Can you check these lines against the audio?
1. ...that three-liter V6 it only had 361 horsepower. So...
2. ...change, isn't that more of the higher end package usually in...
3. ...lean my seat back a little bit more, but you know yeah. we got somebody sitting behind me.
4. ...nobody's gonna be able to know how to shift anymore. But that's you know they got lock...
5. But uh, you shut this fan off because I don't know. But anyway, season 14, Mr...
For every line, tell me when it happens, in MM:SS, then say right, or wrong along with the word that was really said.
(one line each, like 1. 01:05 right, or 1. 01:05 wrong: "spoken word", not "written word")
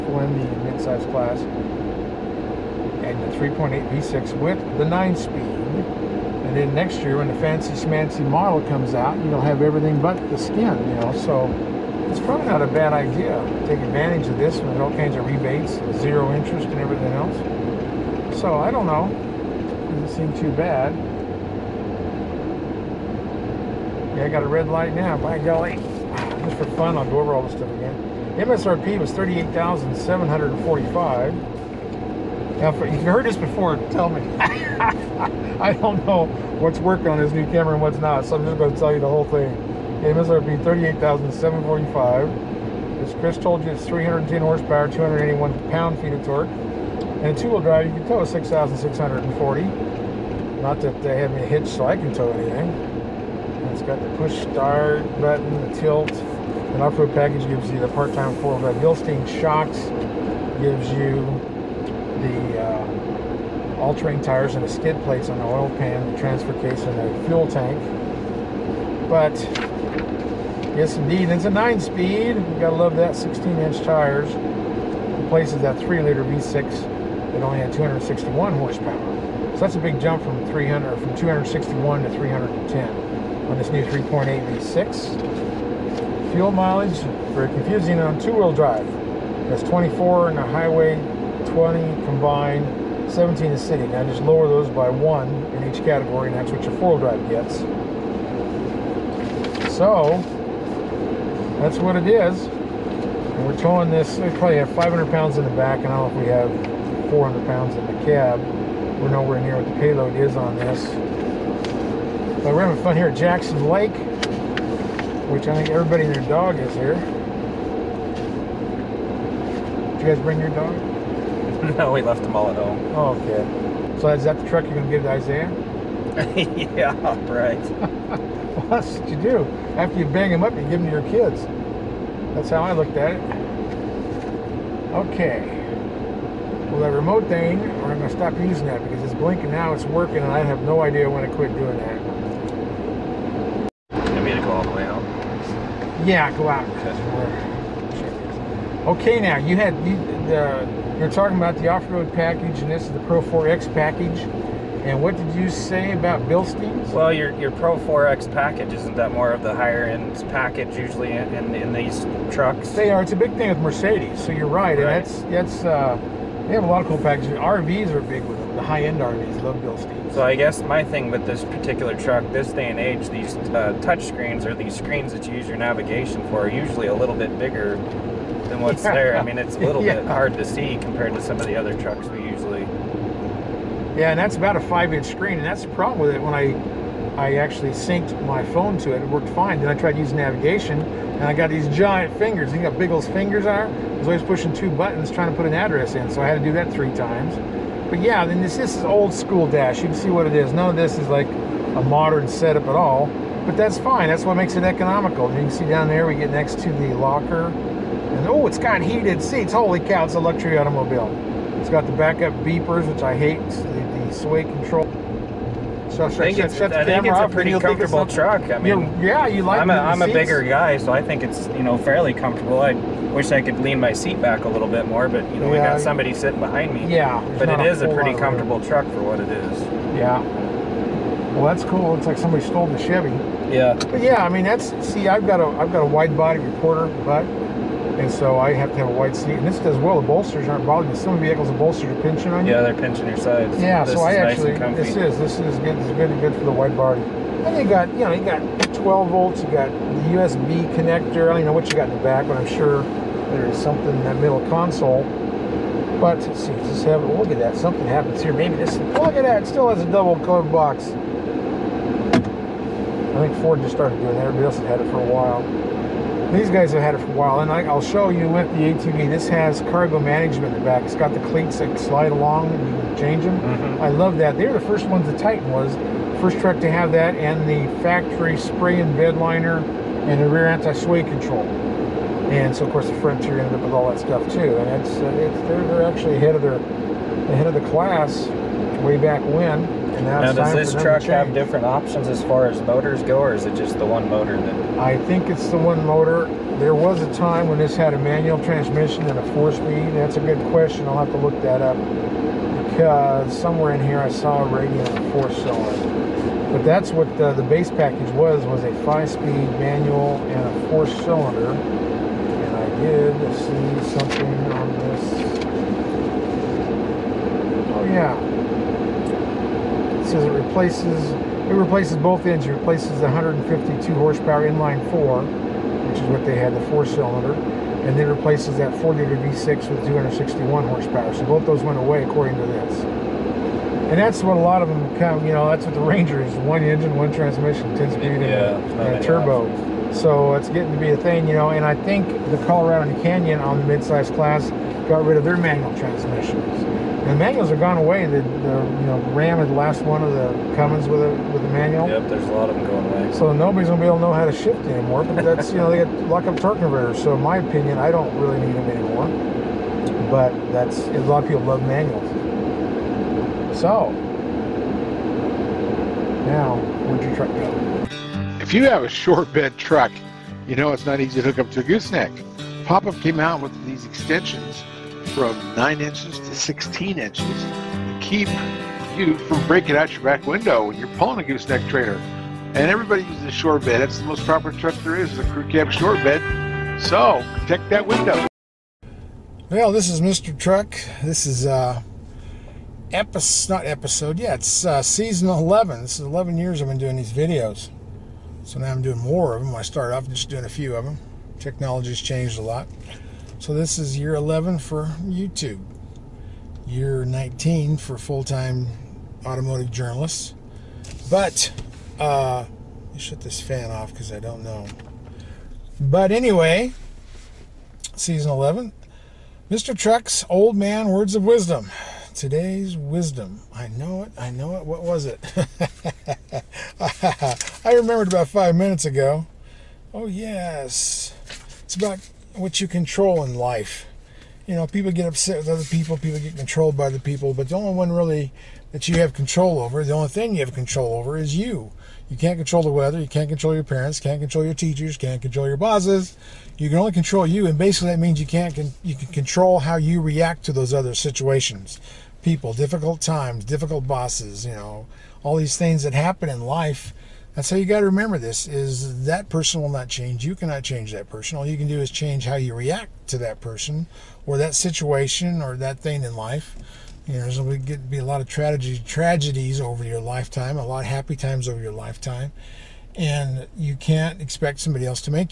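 1. 01:15 wrong: "261", not "361"
2. 02:38 wrong: "package", not "change"
3. 03:43 right
4. 05:53 right
5. 06:51 wrong: "11", not "14".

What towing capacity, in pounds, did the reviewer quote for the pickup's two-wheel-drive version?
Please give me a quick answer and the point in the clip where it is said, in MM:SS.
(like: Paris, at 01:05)
6,640, at 00:48.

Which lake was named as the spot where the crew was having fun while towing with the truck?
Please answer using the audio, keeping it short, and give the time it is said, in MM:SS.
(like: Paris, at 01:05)
Jackson Lake, at 01:53.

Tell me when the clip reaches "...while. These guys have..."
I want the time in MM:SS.
04:25.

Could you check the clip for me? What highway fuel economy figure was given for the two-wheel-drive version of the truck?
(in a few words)
24.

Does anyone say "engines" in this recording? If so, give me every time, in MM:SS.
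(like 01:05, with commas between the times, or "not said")
05:22, 05:36.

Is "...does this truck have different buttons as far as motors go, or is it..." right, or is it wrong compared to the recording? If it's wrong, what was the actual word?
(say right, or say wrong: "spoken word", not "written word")
wrong: "options", not "buttons".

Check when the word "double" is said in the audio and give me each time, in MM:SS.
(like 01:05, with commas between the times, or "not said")
04:19.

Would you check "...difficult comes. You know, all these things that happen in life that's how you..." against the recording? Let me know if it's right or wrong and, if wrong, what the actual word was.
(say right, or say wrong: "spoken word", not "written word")
wrong: "bosses", not "comes".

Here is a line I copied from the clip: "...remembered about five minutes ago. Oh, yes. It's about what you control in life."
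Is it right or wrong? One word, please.
right.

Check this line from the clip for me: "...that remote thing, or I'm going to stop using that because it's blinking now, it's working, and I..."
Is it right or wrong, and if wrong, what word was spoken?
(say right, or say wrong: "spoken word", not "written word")
right.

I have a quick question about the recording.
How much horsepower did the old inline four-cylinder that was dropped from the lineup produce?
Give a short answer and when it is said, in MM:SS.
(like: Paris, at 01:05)
152, at 05:23.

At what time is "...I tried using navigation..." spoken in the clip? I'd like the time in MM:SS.
03:09.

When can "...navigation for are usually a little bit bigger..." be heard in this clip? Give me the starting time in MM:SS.
02:55.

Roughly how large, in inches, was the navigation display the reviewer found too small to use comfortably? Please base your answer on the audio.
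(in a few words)
5 inches.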